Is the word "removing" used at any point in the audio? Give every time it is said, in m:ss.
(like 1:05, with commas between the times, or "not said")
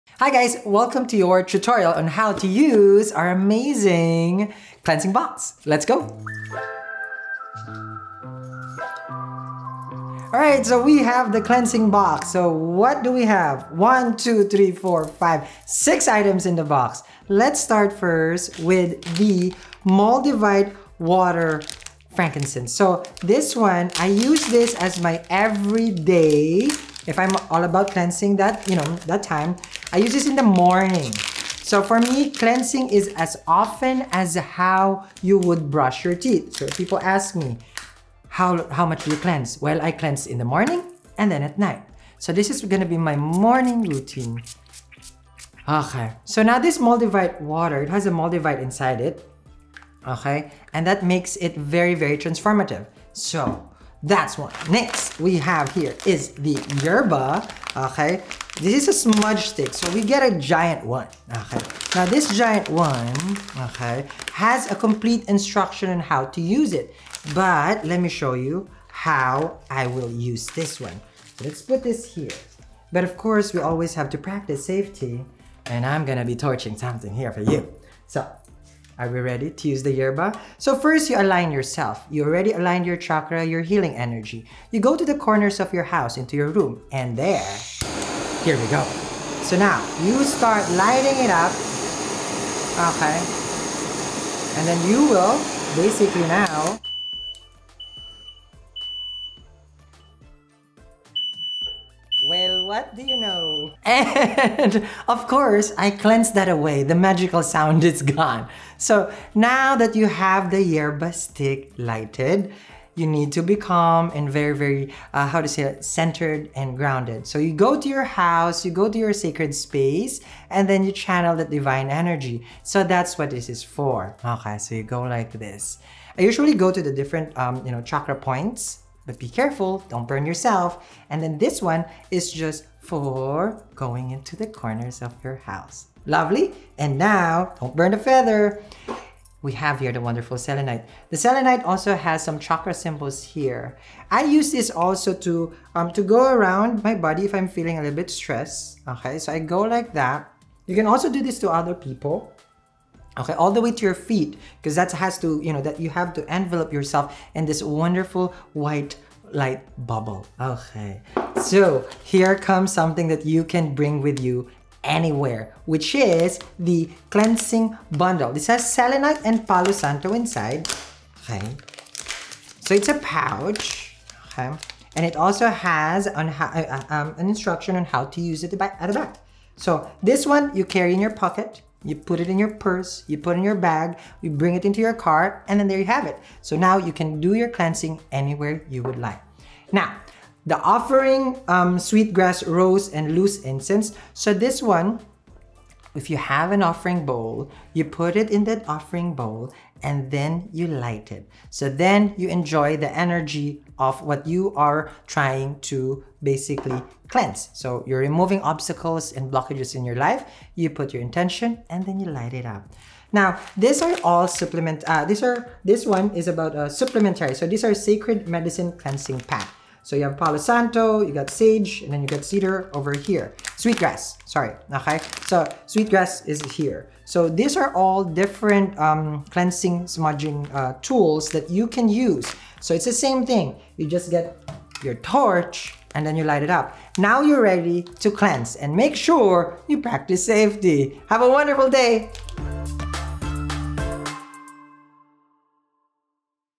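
3:27.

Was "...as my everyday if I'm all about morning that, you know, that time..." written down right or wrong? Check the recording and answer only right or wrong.
wrong.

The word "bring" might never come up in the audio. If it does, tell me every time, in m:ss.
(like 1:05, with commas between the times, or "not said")
2:43, 3:04.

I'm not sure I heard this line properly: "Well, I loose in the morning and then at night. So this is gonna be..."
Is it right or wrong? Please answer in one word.
wrong.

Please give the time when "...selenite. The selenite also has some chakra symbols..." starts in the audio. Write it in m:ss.
2:20.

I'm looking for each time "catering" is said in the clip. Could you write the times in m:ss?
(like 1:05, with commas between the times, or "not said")
not said.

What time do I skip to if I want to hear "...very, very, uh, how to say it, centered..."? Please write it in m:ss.
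1:54.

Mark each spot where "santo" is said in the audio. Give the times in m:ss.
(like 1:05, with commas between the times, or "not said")
2:49, 3:40.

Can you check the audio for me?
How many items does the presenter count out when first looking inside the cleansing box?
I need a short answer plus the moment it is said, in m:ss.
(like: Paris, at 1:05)
6, at 0:15.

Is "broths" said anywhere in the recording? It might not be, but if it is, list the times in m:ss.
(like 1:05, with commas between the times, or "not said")
not said.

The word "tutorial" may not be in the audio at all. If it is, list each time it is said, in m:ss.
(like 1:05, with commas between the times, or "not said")
0:01.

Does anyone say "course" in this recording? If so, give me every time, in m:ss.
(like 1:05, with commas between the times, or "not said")
1:13, 1:45.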